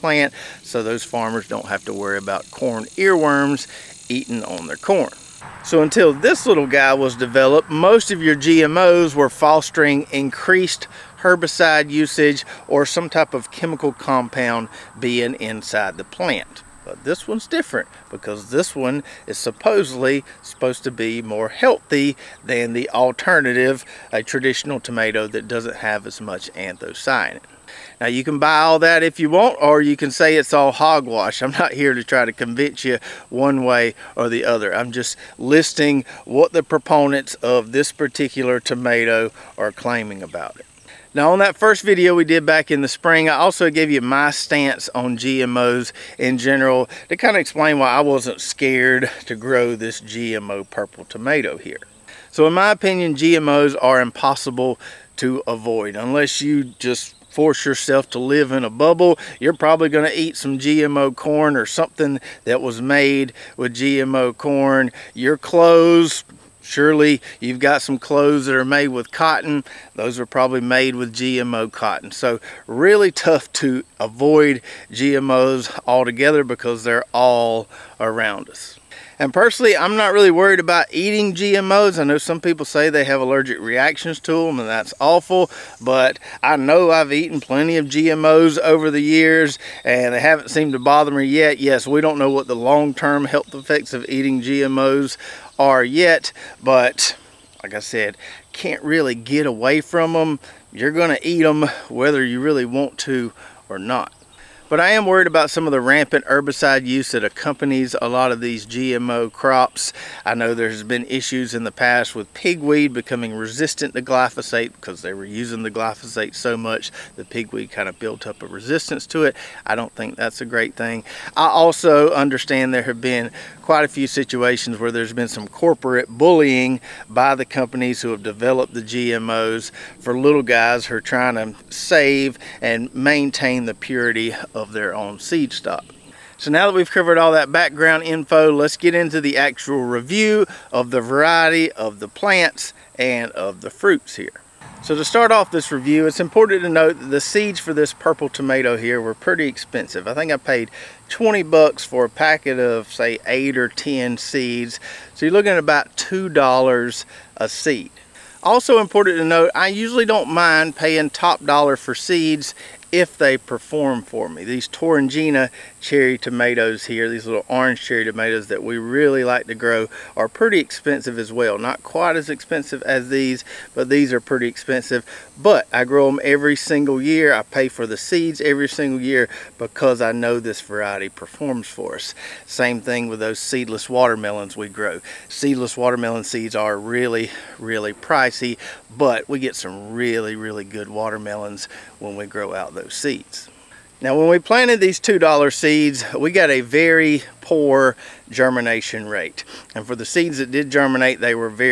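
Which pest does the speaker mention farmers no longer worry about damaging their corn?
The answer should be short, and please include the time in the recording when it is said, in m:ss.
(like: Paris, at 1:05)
Corn earworms, at 0:02.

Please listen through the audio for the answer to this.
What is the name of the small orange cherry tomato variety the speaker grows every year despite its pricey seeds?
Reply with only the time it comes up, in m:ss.
2:44.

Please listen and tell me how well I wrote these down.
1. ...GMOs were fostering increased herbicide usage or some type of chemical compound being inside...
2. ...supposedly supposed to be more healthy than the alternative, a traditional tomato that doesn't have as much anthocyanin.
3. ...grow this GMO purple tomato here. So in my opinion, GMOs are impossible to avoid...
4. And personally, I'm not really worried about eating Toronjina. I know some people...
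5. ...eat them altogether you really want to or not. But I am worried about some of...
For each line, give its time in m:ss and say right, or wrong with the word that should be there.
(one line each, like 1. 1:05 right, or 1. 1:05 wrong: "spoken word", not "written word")
1. 0:08 right
2. 0:19 right
3. 0:49 right
4. 1:19 wrong: "GMOs", not "Toronjina"
5. 1:41 wrong: "whether", not "altogether".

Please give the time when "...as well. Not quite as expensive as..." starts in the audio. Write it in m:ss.
2:51.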